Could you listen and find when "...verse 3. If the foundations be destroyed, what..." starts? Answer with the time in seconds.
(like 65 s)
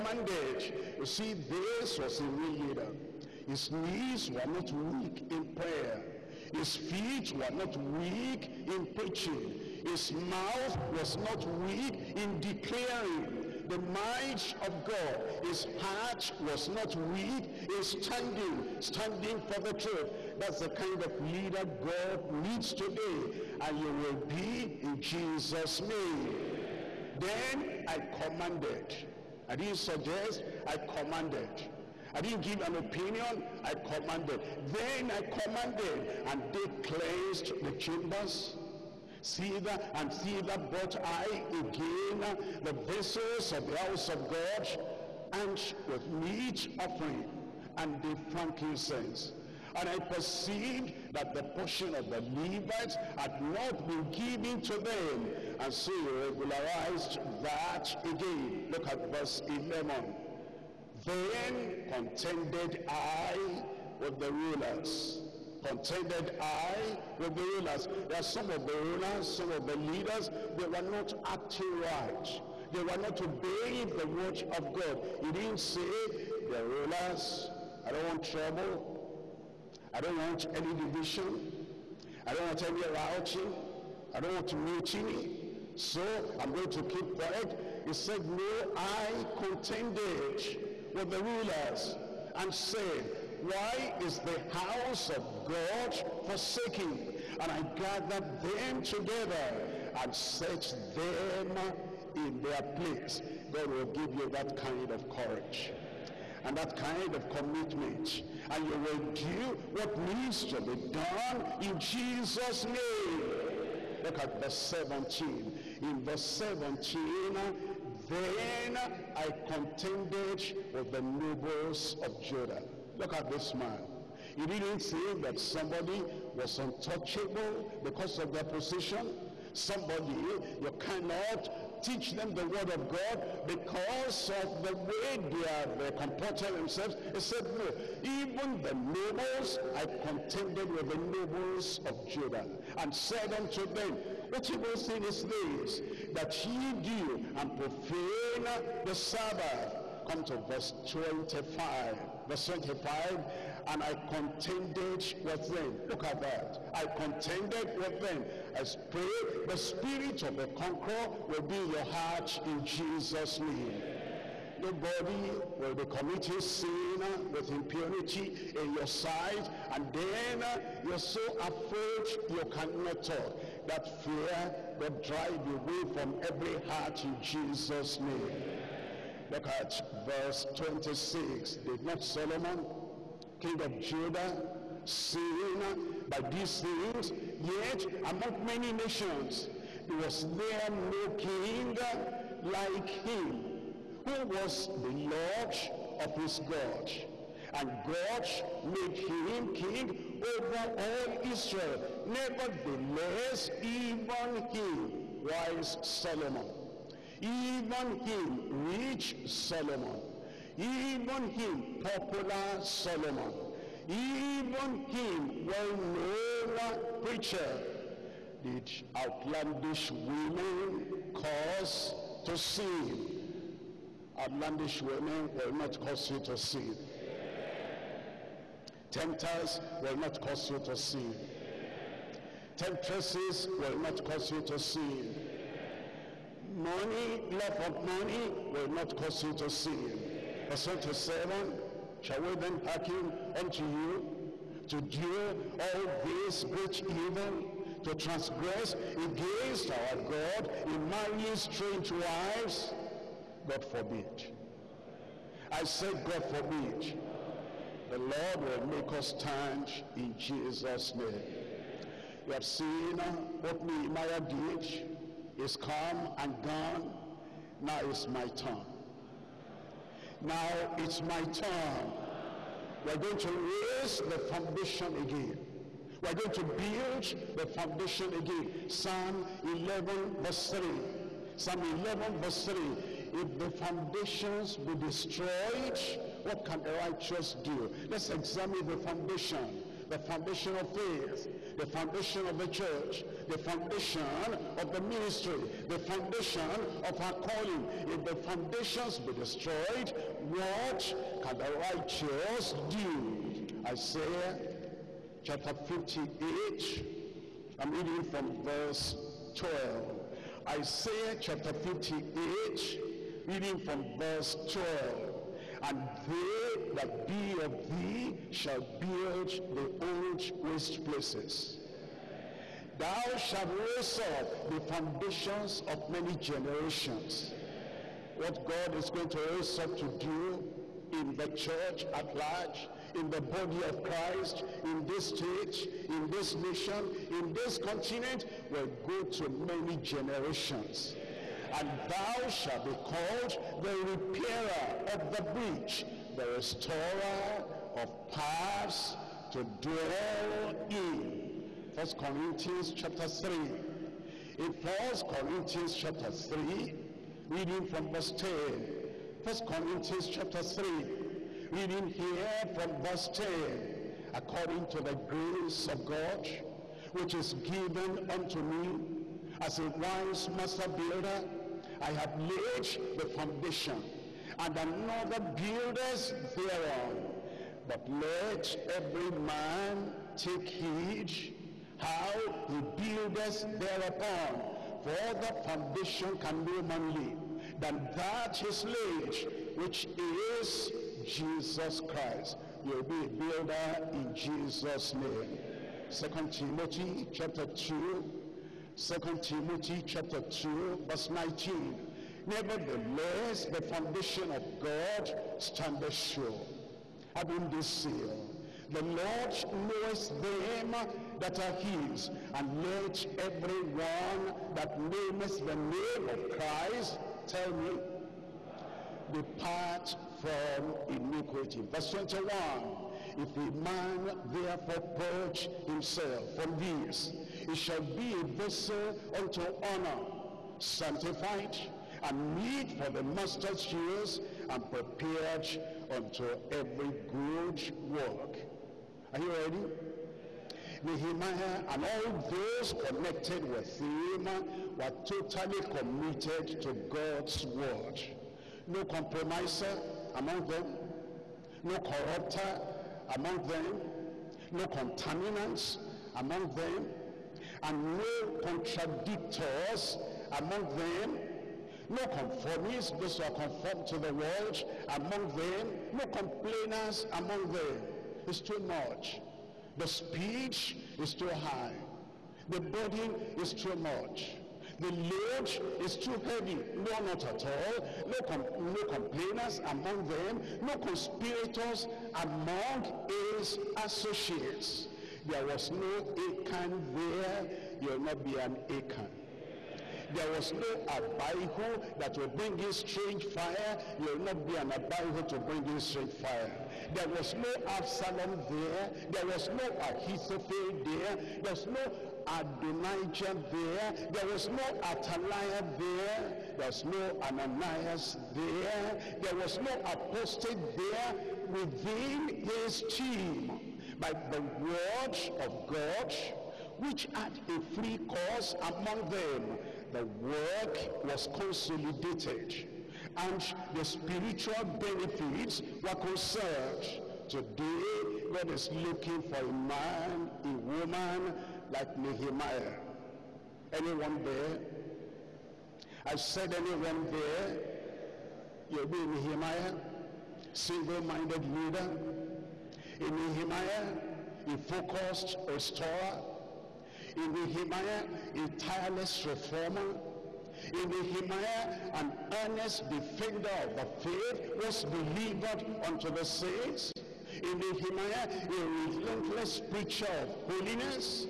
282 s.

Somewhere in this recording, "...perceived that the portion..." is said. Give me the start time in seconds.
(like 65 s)
49 s.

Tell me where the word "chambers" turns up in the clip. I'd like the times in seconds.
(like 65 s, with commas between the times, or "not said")
37 s.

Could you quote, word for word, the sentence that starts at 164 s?
Nobody will be committing sin uh, with impunity in your sight.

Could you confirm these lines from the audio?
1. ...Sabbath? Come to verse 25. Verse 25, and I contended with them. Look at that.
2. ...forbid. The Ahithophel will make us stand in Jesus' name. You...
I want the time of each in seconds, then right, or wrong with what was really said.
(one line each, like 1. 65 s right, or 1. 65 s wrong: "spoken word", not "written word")
1. 148 s right
2. 256 s wrong: "Lord", not "Ahithophel".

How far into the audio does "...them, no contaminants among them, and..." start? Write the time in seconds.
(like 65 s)
453 s.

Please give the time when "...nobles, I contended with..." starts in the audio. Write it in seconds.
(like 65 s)
138 s.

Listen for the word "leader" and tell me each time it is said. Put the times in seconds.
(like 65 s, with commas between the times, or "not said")
2 s, 21 s, 69 s, 541 s.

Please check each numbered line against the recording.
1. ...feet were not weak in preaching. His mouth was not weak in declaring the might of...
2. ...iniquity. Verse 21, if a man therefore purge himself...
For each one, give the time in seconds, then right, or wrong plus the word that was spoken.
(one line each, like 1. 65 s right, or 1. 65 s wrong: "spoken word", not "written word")
1. 6 s right
2. 420 s right.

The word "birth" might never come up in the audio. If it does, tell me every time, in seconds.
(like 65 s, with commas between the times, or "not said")
not said.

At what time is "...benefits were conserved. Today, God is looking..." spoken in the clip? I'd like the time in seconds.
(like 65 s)
524 s.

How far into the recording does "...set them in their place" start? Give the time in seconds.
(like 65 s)
100 s.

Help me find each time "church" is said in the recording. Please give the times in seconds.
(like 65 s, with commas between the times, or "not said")
292 s, 331 s.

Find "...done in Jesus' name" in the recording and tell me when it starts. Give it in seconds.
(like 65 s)
110 s.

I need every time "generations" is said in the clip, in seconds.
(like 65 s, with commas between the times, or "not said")
326 s, 339 s.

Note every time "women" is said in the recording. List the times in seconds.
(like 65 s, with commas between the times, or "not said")
220 s, 224 s.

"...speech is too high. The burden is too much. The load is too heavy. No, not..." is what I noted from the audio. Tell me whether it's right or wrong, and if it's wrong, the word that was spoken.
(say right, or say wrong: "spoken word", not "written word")
right.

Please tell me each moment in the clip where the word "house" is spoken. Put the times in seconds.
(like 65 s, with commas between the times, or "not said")
43 s, 94 s.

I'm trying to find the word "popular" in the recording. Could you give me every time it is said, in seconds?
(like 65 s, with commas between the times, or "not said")
211 s.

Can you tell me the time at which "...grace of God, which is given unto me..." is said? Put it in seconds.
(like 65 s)
365 s.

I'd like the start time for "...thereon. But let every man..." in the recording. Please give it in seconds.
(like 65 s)
376 s.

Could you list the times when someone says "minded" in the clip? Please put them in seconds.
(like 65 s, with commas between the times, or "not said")
540 s.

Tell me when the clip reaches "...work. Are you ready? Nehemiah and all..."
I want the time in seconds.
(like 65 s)
437 s.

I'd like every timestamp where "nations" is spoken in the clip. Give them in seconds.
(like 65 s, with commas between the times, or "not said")
188 s, 336 s.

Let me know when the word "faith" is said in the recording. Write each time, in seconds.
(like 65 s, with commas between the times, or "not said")
290 s, 554 s.